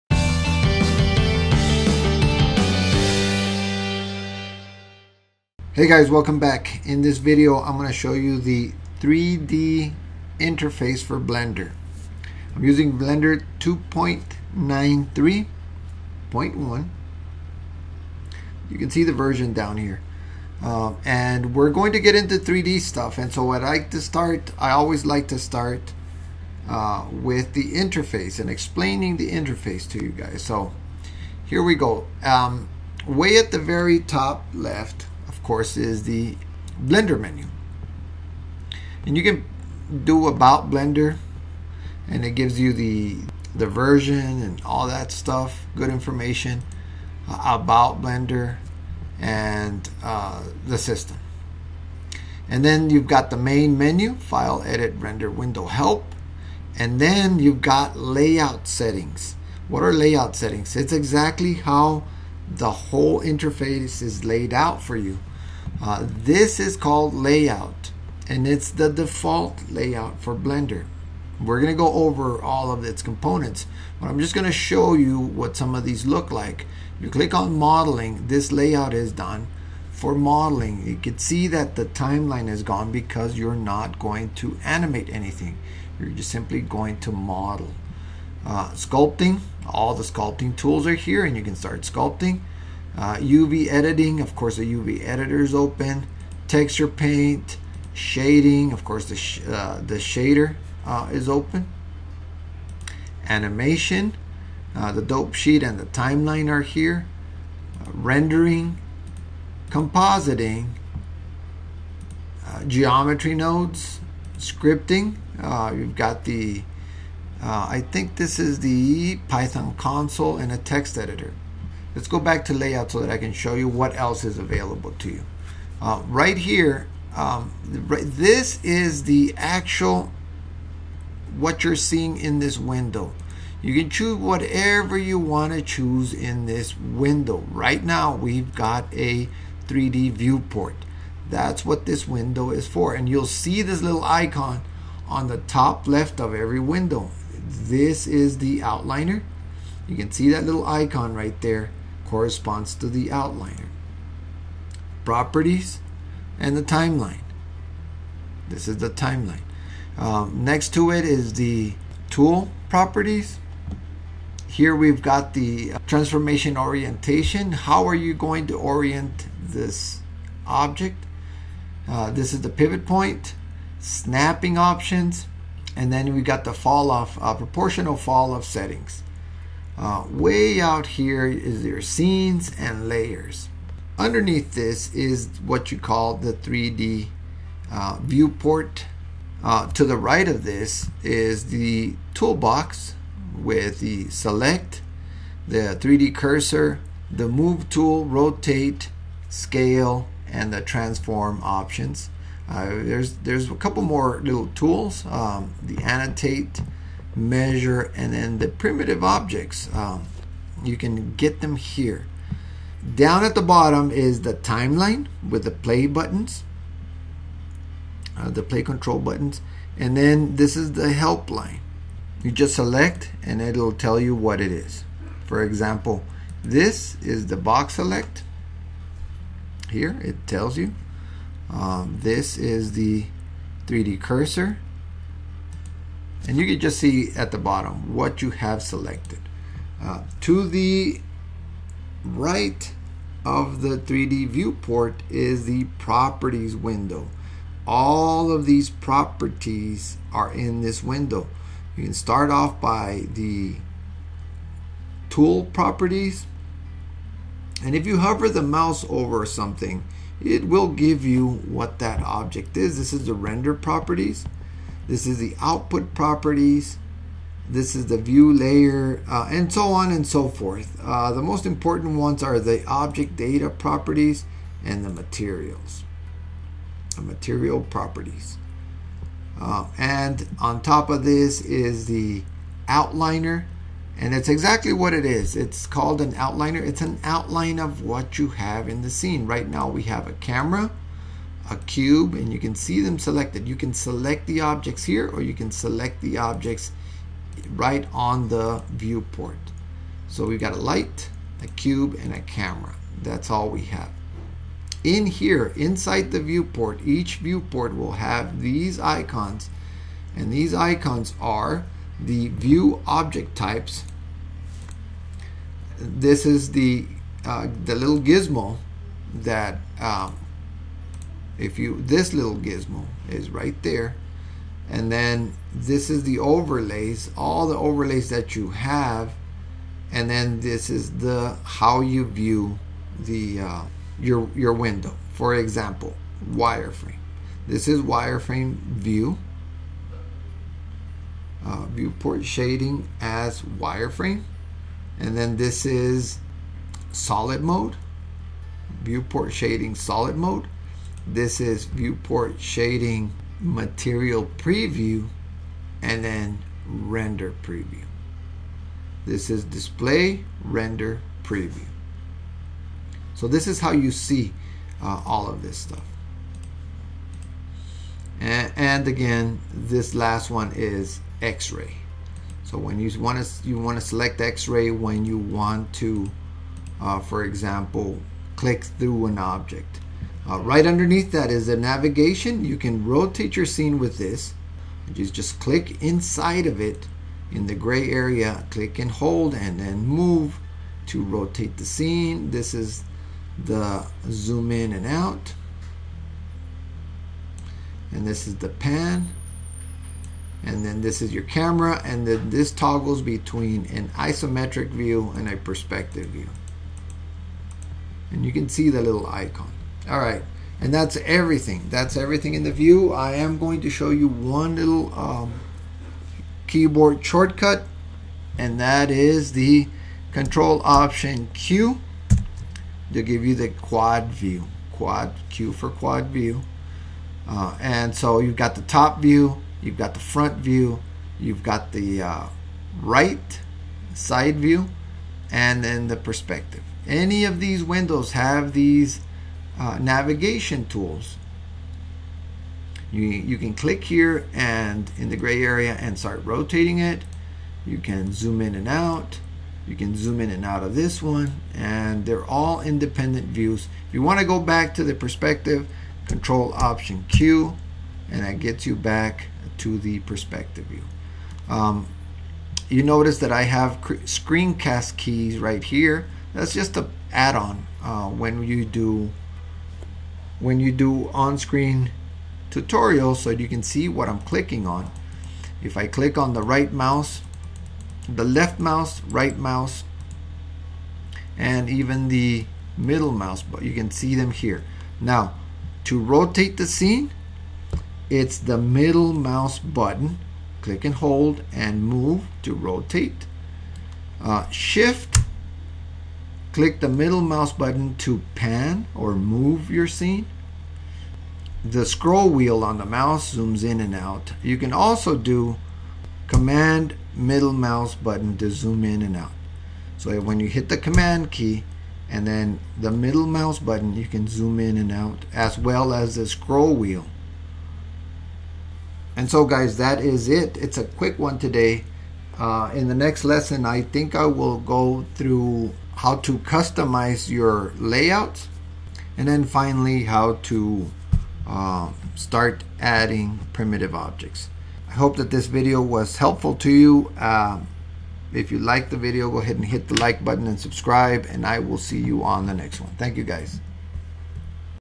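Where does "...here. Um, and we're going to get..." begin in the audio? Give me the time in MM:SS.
00:19.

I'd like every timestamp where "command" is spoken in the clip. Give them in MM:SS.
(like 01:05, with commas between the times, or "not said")
08:26, 08:30.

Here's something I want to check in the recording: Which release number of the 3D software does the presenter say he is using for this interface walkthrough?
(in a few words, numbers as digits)
2.93.1.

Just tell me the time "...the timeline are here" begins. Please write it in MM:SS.
01:45.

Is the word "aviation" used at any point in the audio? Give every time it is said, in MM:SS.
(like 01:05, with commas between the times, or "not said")
not said.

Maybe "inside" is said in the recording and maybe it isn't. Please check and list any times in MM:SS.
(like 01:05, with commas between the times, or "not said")
05:05, 06:25.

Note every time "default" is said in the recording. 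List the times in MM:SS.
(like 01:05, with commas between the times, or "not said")
01:08.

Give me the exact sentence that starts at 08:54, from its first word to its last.
I hope that this video was helpful to you.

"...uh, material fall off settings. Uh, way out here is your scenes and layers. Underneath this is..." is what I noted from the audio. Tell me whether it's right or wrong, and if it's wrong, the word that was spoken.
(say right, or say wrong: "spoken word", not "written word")
wrong: "proportional", not "material".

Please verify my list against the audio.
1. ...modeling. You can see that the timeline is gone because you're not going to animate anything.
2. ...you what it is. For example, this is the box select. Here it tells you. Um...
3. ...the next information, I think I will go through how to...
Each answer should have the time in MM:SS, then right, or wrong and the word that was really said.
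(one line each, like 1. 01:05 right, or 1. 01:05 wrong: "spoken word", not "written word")
1. 01:20 right
2. 03:43 right
3. 08:42 wrong: "lesson", not "information".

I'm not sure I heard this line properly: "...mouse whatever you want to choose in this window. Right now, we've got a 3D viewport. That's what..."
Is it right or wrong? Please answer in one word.
wrong.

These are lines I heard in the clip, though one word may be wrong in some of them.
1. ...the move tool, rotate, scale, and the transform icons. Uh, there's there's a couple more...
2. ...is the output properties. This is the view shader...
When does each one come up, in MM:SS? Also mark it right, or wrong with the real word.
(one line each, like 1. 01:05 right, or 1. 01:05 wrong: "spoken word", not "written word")
1. 03:17 wrong: "options", not "icons"
2. 04:25 wrong: "layer", not "shader".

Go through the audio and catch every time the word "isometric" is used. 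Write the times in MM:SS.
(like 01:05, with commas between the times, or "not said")
06:43.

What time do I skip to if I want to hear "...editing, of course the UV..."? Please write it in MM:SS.
01:33.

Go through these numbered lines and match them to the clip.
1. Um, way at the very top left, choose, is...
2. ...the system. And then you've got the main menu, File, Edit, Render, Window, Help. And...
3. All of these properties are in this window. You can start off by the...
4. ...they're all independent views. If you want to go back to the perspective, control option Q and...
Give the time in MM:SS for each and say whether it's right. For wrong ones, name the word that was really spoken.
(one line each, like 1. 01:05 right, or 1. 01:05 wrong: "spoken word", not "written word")
1. 00:32 wrong: "course", not "choose"
2. 00:50 right
3. 04:07 right
4. 07:32 right.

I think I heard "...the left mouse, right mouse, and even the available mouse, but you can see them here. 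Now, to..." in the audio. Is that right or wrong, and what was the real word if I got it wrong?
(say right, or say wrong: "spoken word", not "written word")
wrong: "middle", not "available".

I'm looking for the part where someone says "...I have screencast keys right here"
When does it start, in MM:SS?
07:43.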